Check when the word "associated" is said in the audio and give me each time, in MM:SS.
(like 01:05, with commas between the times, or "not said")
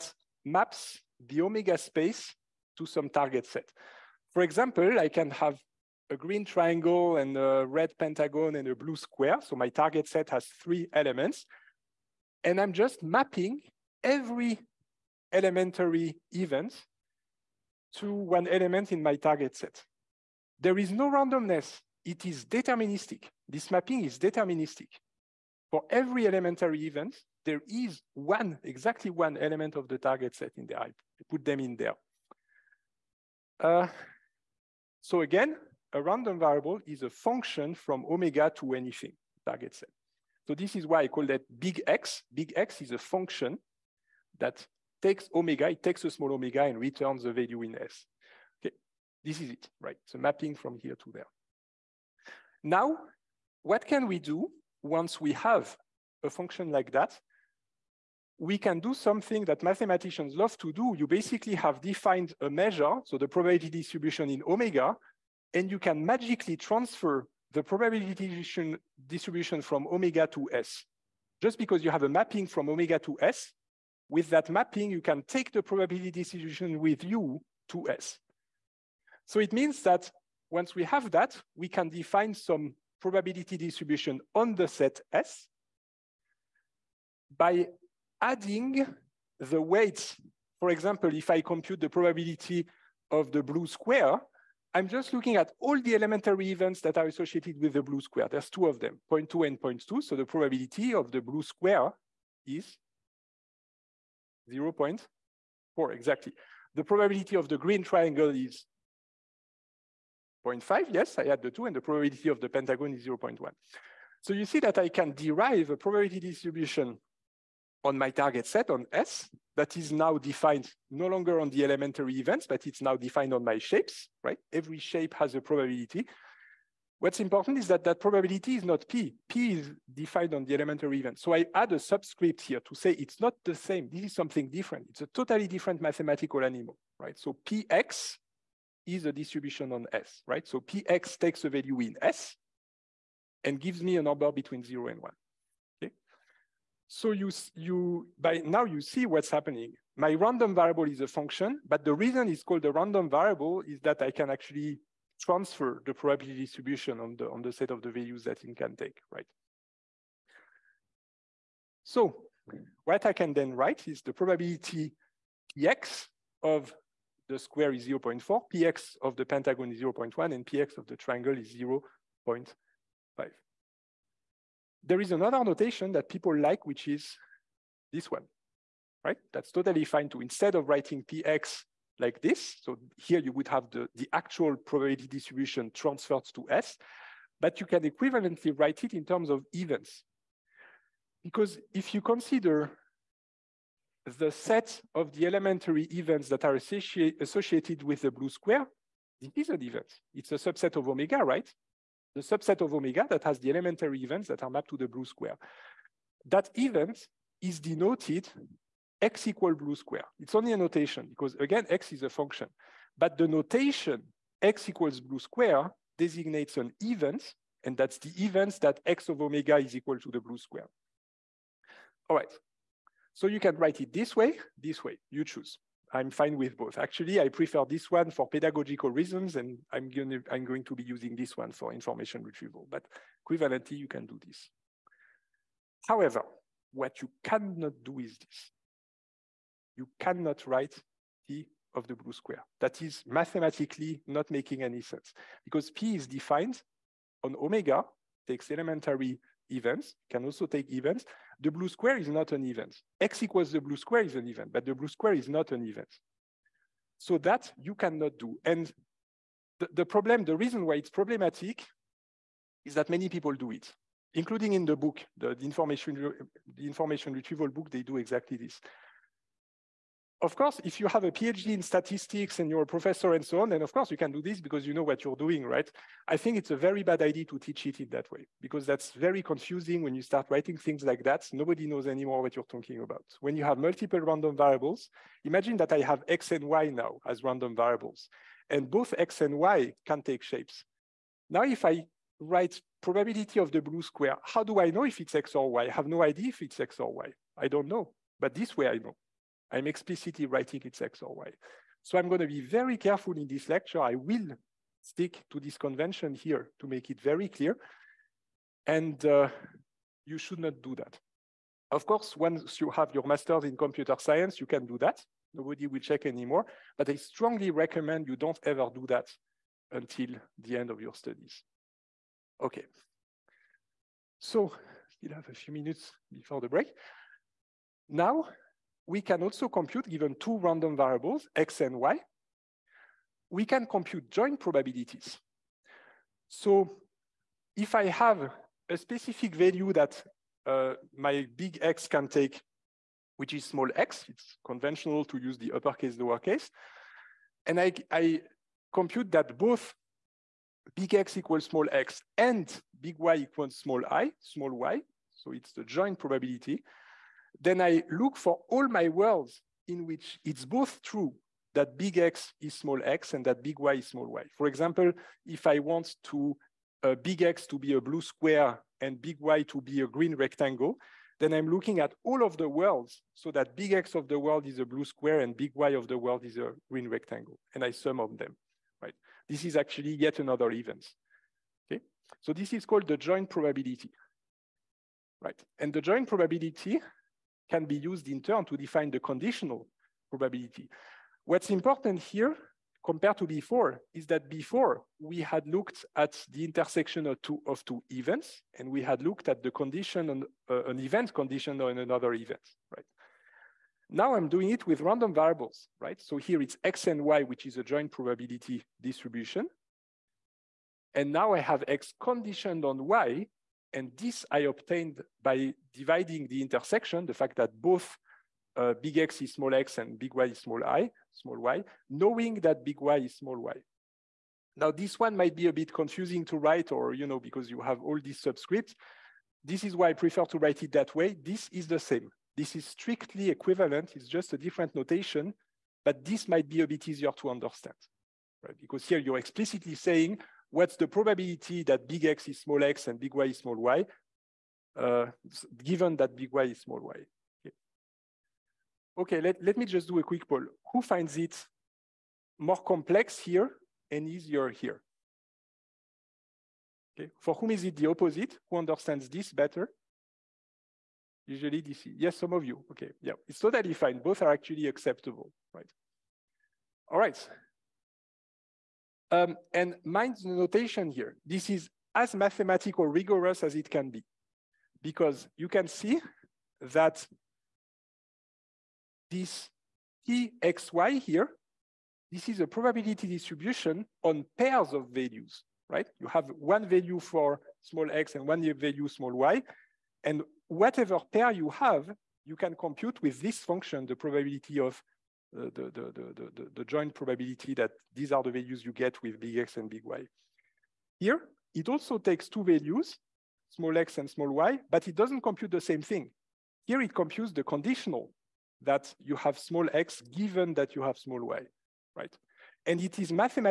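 01:37, 03:16.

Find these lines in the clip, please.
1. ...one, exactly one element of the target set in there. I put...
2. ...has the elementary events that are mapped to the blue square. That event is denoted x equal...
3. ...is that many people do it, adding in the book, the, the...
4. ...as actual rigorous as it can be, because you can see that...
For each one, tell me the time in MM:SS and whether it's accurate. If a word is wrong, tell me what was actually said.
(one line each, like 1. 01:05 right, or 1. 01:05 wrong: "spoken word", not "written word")
1. 00:28 right
2. 03:23 right
3. 04:22 wrong: "including", not "adding"
4. 07:51 wrong: "mathematical", not "actual".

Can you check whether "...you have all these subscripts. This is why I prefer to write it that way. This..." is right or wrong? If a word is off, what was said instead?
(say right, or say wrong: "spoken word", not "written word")
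right.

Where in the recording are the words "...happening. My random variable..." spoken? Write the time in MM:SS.
02:29.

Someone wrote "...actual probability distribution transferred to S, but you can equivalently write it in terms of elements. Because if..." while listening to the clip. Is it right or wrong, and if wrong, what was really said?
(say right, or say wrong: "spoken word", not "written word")
wrong: "events", not "elements".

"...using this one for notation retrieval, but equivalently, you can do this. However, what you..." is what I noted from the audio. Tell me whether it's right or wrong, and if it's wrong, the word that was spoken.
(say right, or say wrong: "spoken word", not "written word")
wrong: "information", not "notation".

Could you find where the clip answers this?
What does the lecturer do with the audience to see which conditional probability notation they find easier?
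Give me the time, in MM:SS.
07:30.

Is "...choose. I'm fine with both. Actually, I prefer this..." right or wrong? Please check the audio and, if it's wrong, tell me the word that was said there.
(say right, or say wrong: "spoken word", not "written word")
right.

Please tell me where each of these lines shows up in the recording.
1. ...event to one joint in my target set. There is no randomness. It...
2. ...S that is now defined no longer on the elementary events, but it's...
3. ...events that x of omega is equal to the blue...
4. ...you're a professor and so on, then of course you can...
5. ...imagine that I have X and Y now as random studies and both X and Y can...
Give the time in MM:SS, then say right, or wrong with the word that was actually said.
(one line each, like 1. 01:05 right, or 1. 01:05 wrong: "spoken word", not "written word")
1. 00:16 wrong: "element", not "joint"
2. 01:58 right
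3. 03:38 right
4. 04:32 right
5. 04:45 wrong: "variables", not "studies".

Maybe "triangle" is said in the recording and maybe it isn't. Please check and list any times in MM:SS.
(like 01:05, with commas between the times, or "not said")
00:06, 01:47, 02:50.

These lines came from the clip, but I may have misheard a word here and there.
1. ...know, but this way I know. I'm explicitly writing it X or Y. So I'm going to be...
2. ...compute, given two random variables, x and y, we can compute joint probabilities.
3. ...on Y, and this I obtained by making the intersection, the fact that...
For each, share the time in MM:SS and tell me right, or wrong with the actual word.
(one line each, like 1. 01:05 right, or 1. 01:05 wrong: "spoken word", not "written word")
1. 04:57 right
2. 05:29 right
3. 06:52 wrong: "dividing", not "making".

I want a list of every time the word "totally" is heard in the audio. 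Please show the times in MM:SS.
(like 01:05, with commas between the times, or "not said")
02:15, 02:59, 07:43.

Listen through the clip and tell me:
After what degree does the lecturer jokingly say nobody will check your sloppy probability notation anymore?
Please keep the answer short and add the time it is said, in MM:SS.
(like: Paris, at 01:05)
master's in computer science, at 05:13.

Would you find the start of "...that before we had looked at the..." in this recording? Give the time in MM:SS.
06:34.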